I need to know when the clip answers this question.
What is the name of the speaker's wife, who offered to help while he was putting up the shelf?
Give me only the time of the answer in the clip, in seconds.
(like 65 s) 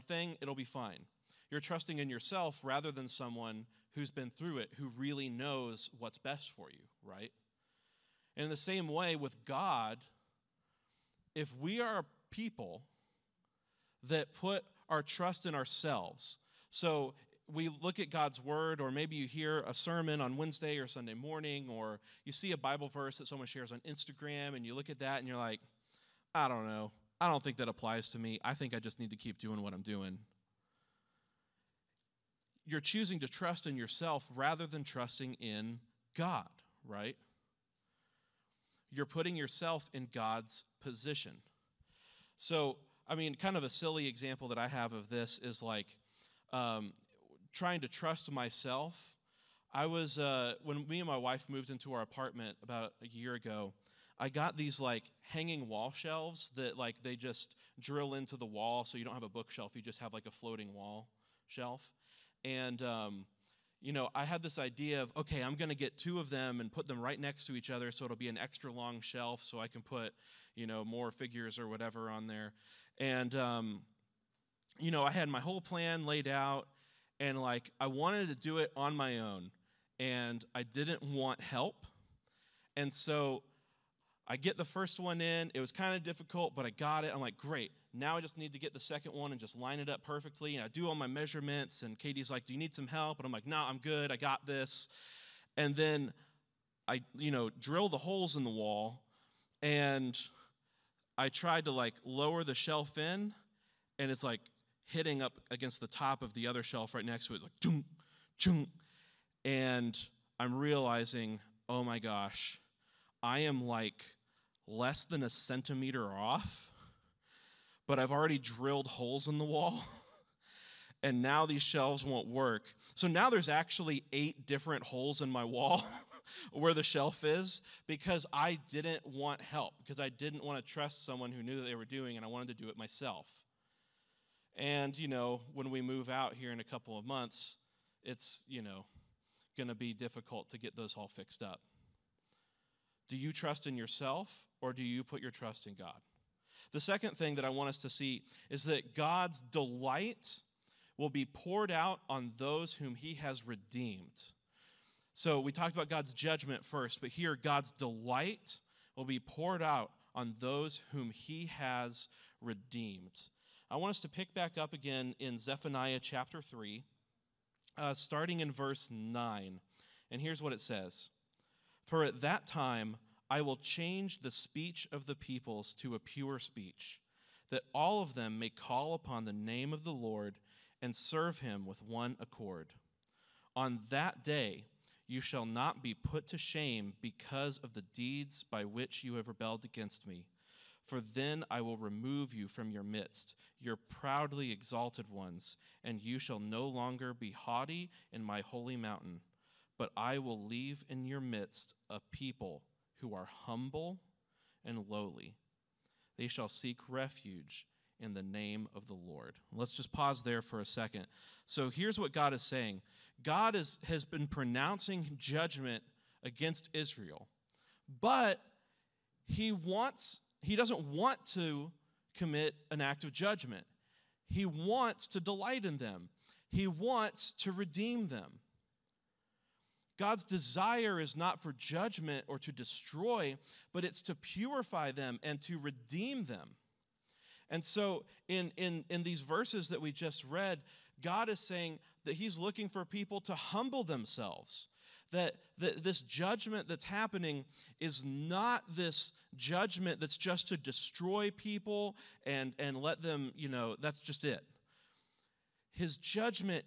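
91 s.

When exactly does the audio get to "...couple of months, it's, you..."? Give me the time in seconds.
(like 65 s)
136 s.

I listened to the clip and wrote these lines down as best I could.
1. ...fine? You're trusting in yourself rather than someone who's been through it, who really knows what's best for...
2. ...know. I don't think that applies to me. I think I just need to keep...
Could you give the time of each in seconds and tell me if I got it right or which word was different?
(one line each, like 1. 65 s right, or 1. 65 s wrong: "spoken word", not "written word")
1. 0 s right
2. 26 s right.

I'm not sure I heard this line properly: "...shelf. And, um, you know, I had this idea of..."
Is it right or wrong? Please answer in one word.
right.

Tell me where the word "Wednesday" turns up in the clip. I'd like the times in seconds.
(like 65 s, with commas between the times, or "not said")
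20 s.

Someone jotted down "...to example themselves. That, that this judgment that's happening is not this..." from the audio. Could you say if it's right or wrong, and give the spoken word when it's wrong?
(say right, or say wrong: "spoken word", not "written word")
wrong: "humble", not "example".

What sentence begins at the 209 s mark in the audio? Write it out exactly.
Let's just pause there for a second.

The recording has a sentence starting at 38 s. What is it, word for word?
you're putting yourself in God's position.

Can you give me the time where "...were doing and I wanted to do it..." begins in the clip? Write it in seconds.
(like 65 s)
131 s.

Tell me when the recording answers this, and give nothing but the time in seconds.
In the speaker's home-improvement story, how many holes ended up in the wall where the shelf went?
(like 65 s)
124 s.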